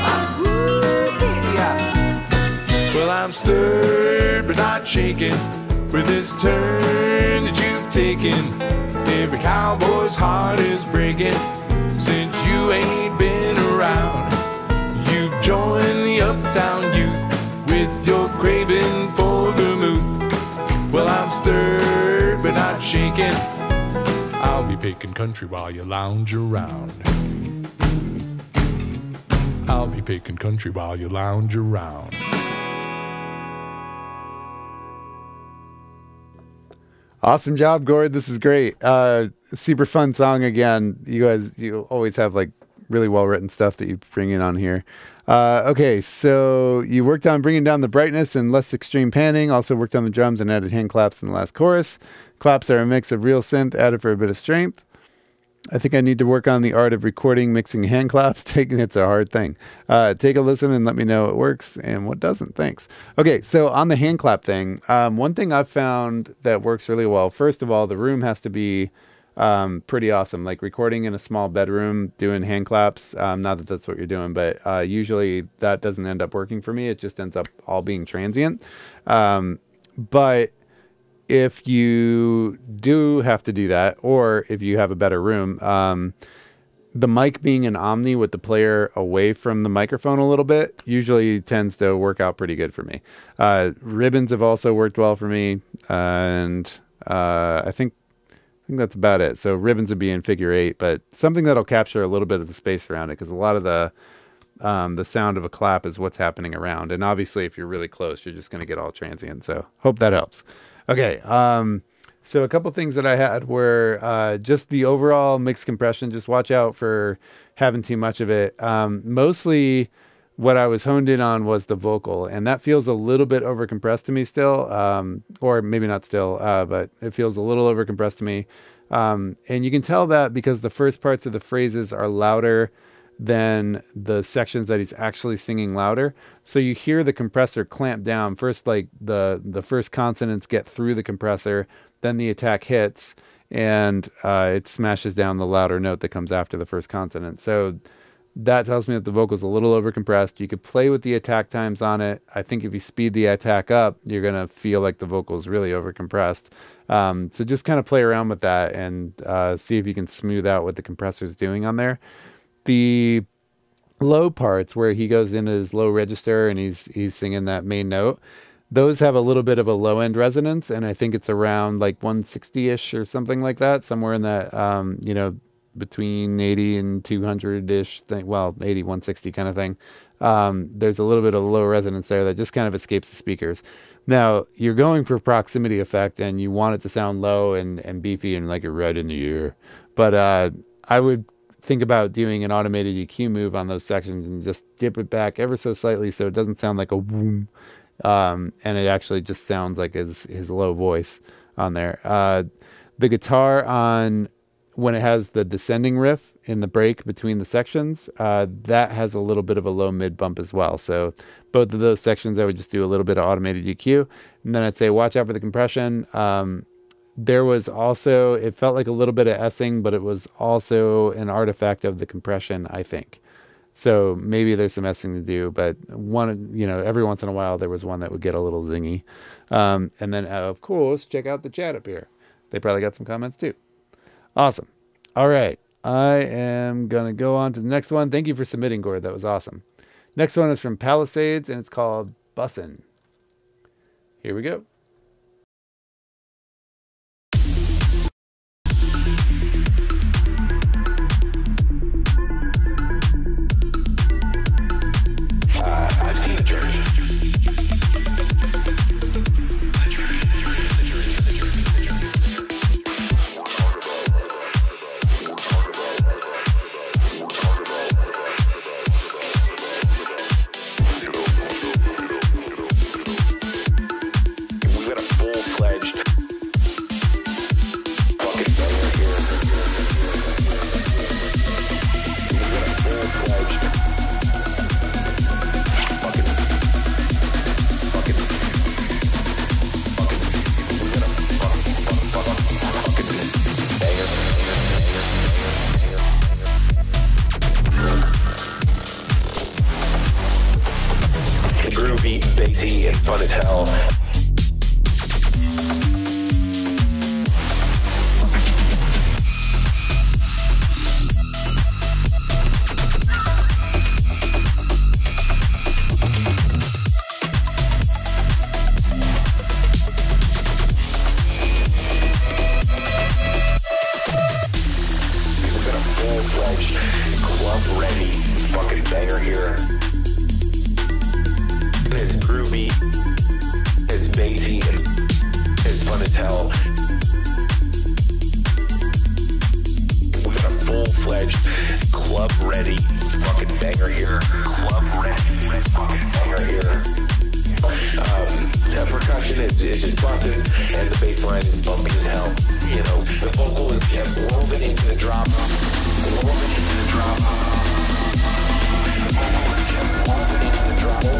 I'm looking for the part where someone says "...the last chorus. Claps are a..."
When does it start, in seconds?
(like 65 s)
51 s.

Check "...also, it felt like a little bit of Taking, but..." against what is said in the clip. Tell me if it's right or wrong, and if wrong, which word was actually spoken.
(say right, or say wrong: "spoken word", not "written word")
wrong: "Essing", not "Taking".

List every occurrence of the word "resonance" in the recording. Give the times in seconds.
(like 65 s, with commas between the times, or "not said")
170 s, 181 s.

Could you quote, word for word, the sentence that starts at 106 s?
And obviously, if you're really close, you're just going to get all transient.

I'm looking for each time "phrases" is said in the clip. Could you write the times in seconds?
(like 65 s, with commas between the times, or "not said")
131 s.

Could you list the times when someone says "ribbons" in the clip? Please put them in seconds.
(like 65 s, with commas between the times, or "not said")
93 s, 99 s.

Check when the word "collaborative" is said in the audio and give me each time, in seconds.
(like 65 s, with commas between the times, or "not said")
not said.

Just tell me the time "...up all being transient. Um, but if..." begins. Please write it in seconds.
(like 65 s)
77 s.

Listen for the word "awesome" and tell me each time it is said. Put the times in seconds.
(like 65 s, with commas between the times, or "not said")
37 s, 70 s, 234 s, 239 s.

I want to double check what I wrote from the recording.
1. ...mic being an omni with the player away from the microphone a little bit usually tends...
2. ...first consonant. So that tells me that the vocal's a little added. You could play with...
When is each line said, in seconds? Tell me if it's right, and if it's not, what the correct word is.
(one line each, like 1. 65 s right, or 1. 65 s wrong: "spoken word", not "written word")
1. 87 s right
2. 146 s wrong: "overcompressed", not "added".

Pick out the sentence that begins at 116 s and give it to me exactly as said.
Just watch out for having too much of it.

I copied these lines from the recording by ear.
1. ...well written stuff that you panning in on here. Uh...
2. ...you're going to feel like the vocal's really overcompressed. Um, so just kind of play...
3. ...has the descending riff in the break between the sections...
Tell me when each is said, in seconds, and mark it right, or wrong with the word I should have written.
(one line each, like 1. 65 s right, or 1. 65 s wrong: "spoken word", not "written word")
1. 43 s wrong: "bring", not "panning"
2. 154 s right
3. 204 s right.